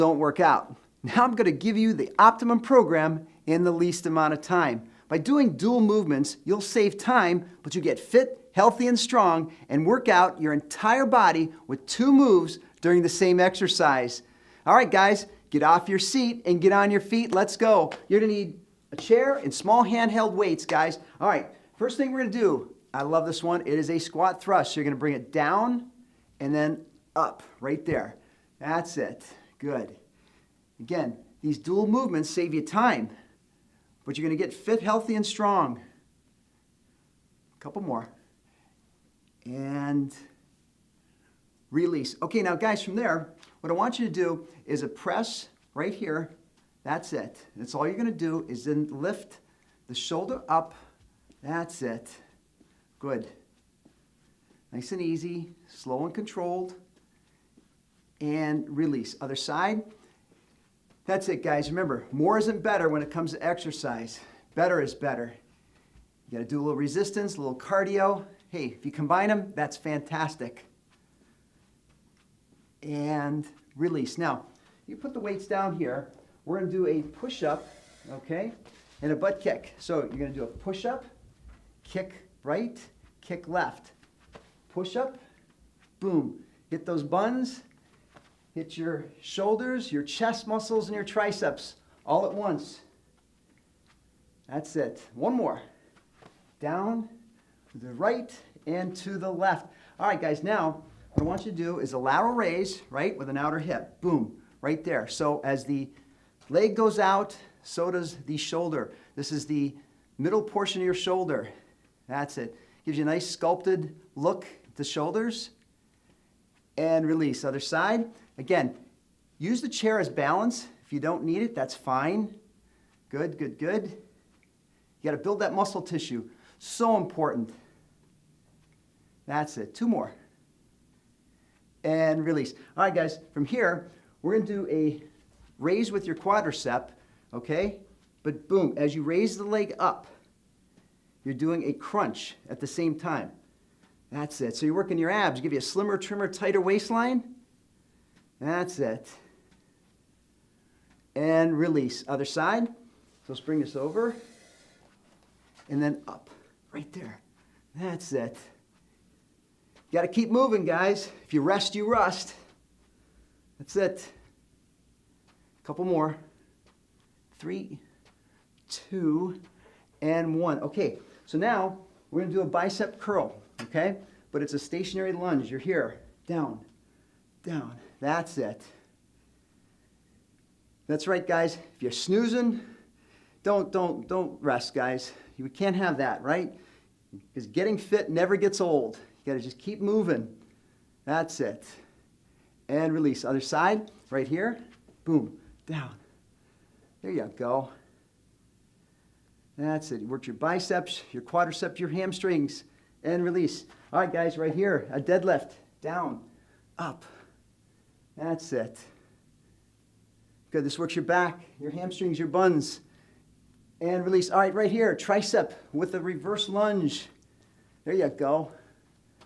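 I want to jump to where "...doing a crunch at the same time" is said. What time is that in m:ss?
2:21.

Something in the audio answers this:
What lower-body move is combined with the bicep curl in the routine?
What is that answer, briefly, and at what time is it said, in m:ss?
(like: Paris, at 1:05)
Stationary lunge, at 2:54.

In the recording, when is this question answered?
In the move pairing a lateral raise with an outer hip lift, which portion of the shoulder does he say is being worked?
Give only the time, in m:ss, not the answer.
1:50.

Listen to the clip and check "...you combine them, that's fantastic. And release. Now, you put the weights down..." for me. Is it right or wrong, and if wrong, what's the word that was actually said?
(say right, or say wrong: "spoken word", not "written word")
right.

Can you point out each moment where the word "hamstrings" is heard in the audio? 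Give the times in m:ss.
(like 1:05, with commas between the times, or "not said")
3:21, 3:31.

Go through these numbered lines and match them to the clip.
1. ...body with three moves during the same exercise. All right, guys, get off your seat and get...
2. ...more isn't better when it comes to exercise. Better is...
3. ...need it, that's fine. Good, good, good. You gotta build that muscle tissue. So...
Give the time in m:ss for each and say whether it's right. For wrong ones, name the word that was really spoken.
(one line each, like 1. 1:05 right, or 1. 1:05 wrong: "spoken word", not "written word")
1. 0:11 wrong: "two", not "three"
2. 1:02 right
3. 2:01 right.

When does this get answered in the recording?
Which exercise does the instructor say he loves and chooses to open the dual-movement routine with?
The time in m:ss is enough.
0:23.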